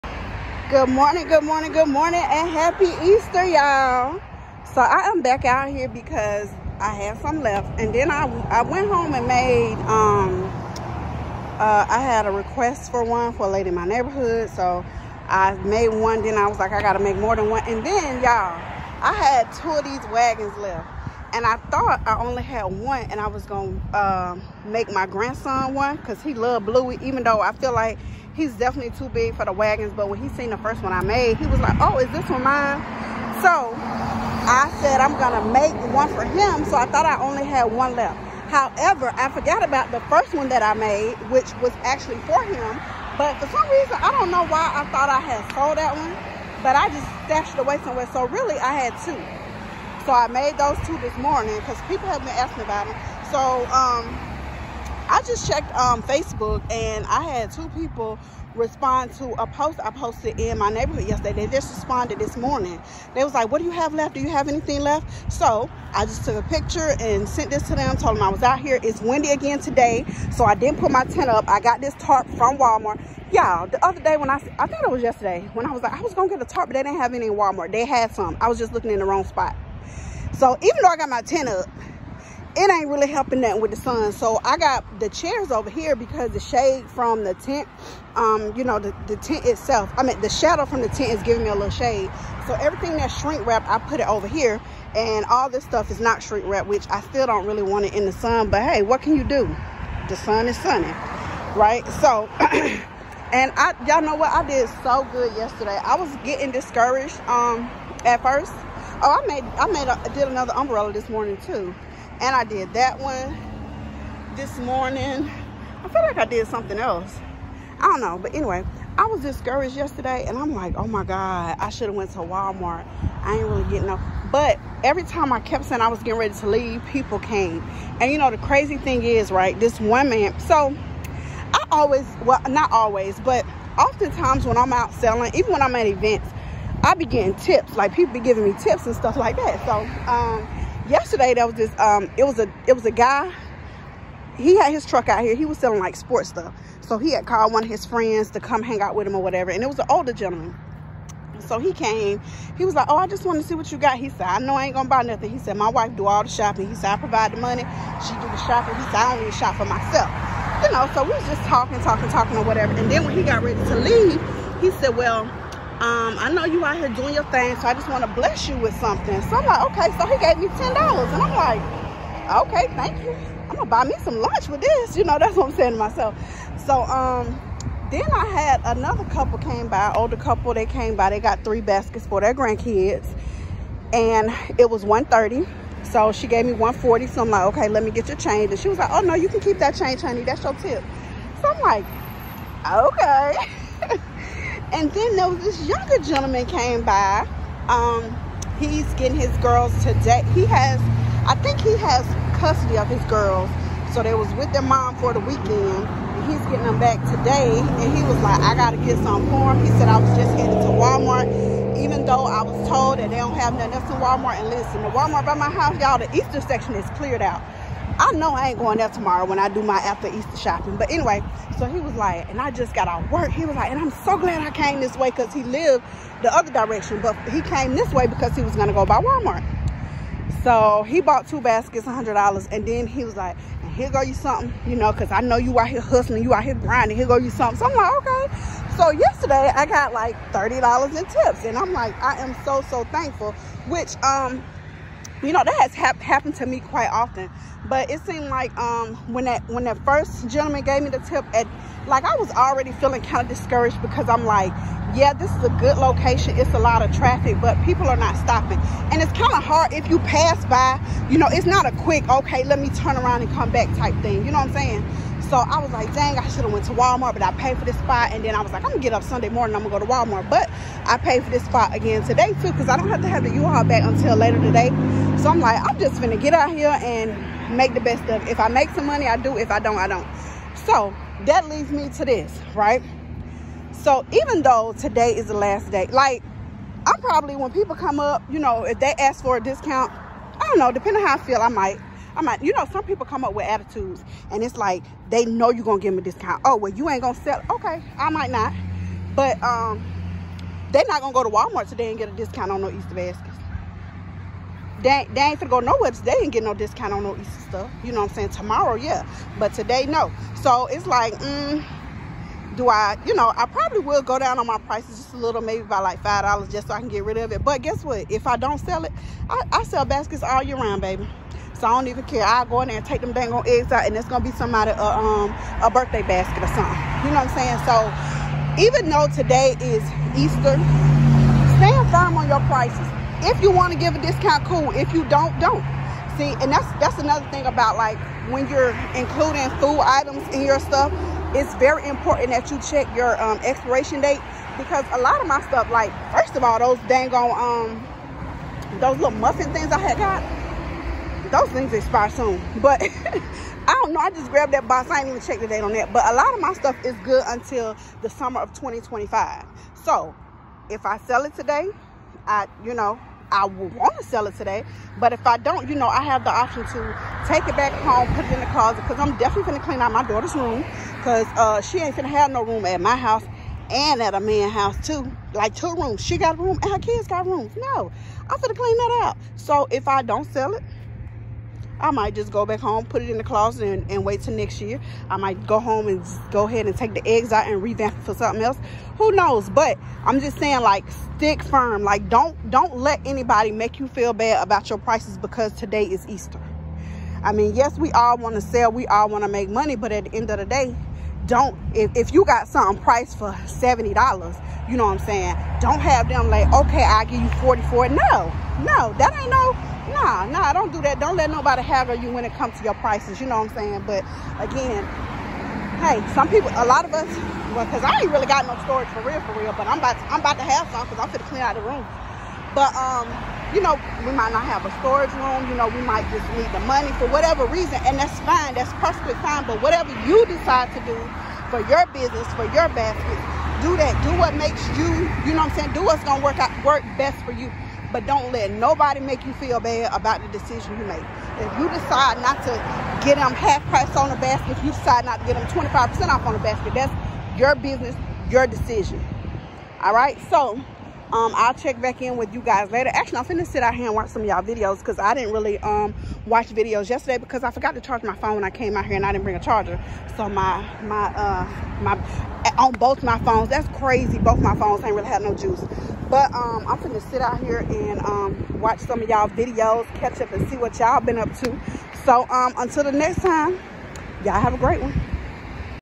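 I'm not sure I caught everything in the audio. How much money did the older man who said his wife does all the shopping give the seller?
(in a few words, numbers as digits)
$10.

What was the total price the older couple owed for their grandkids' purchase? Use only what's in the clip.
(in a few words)
130.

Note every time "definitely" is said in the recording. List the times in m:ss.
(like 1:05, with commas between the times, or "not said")
0:28, 6:09.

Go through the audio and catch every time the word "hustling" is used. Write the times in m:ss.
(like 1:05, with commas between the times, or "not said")
3:55.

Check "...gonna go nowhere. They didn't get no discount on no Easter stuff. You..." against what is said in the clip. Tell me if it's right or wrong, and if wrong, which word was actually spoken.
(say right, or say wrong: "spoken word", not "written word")
right.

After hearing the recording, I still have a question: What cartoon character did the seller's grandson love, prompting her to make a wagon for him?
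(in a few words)
Bluey.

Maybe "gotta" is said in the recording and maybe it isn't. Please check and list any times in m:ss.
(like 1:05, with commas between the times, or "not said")
0:16, 3:28.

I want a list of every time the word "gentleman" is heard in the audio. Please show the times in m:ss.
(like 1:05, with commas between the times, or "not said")
2:30, 3:15, 4:10.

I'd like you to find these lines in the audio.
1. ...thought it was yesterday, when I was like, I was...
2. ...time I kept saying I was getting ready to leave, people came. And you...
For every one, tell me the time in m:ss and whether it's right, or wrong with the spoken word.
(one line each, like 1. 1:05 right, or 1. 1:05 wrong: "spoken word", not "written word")
1. 1:14 right
2. 2:05 right.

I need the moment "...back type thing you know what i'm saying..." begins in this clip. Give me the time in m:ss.
4:23.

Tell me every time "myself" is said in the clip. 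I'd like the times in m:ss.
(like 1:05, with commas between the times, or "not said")
2:39, 2:55.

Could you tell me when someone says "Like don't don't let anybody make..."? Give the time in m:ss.
6:31.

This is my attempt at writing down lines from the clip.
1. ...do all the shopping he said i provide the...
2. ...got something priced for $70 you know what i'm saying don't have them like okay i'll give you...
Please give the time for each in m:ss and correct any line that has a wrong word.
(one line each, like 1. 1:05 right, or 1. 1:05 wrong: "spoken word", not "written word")
1. 2:35 right
2. 6:42 right.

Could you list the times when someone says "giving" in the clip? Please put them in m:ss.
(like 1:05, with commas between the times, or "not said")
1:31, 2:18.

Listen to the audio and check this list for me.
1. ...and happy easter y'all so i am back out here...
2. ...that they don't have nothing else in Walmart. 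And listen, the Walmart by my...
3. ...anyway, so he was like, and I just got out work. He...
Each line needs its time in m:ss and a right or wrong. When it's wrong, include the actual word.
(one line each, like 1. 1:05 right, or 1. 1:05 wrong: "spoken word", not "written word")
1. 0:02 right
2. 3:32 right
3. 3:40 right.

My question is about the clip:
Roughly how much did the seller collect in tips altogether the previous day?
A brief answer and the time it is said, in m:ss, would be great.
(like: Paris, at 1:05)
$30, at 4:00.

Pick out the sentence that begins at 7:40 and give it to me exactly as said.
So my, my, uh, my, on both my phones, that's crazy.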